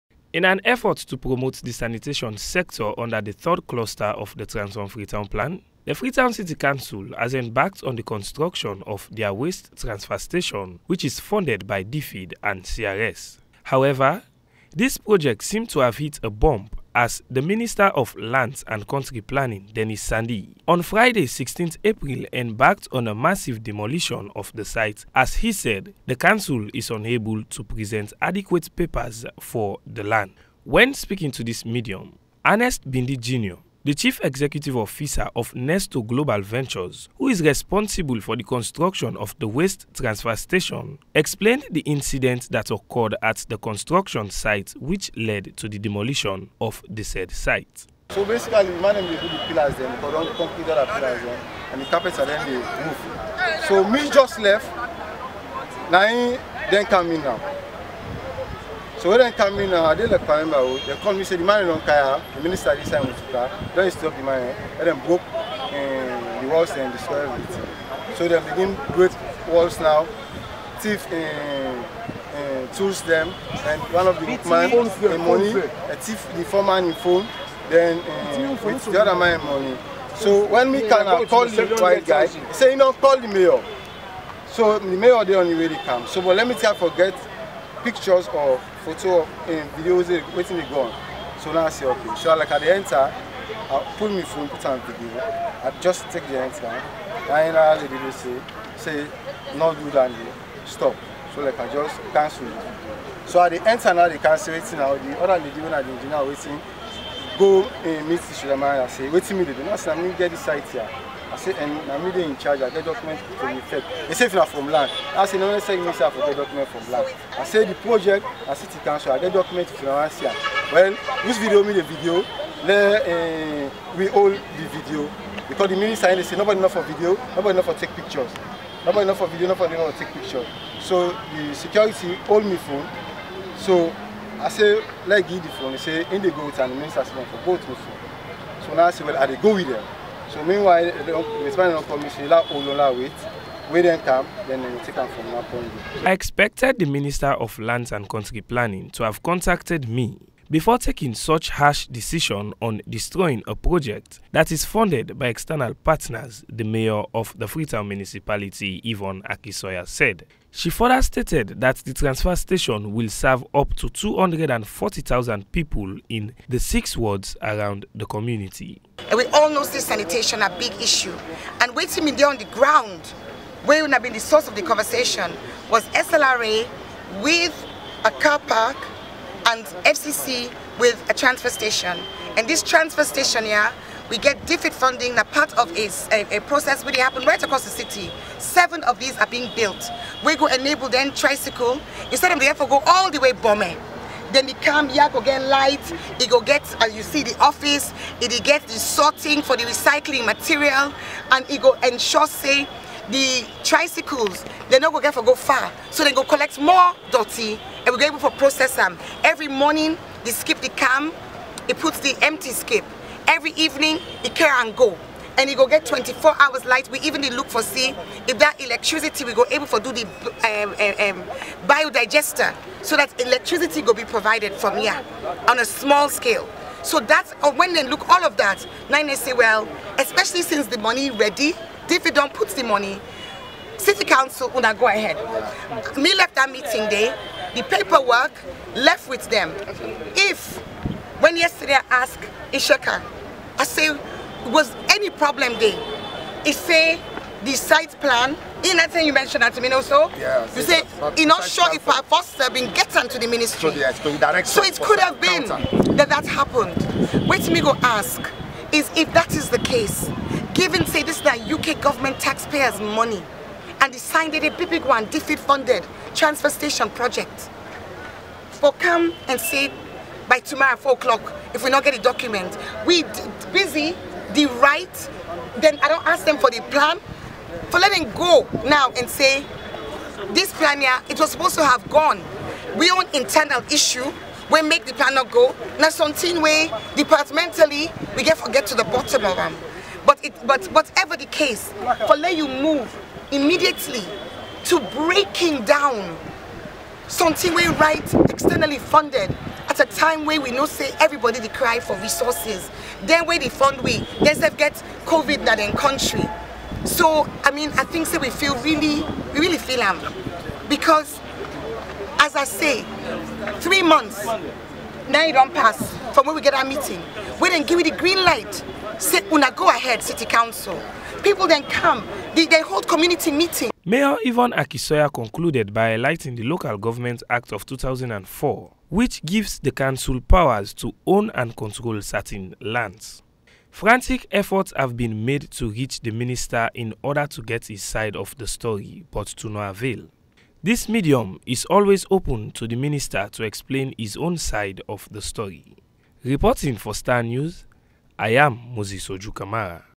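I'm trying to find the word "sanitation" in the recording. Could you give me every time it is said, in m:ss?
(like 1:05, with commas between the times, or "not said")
0:01, 2:49.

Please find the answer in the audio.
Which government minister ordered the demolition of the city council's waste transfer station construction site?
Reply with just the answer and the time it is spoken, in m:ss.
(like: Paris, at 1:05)
Denis Sandi, at 0:19.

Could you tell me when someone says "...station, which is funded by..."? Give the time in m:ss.
0:10.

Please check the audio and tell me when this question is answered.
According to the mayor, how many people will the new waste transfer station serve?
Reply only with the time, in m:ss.
2:43.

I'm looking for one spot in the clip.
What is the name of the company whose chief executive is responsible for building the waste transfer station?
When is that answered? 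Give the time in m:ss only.
0:35.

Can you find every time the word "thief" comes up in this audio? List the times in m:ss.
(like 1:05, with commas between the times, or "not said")
1:10, 1:15.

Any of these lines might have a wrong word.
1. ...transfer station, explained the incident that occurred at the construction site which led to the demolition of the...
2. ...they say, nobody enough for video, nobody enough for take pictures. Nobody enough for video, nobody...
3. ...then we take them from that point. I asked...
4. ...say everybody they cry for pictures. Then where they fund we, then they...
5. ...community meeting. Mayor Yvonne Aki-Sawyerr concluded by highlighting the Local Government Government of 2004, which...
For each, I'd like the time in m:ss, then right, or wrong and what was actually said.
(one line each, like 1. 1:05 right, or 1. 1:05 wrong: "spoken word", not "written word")
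1. 0:39 right
2. 2:06 right
3. 2:24 wrong: "expected", not "asked"
4. 5:00 wrong: "resources", not "pictures"
5. 5:22 wrong: "Act", not "Government".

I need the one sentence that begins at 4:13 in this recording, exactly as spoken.
So, yes, so it could have been counter.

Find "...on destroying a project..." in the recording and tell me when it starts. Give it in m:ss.
2:32.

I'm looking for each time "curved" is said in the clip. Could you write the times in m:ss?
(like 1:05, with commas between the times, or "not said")
not said.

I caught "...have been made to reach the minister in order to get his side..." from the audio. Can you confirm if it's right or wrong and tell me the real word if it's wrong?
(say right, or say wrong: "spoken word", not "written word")
right.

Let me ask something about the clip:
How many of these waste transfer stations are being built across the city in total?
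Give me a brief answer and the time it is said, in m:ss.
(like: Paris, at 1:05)
7, at 3:08.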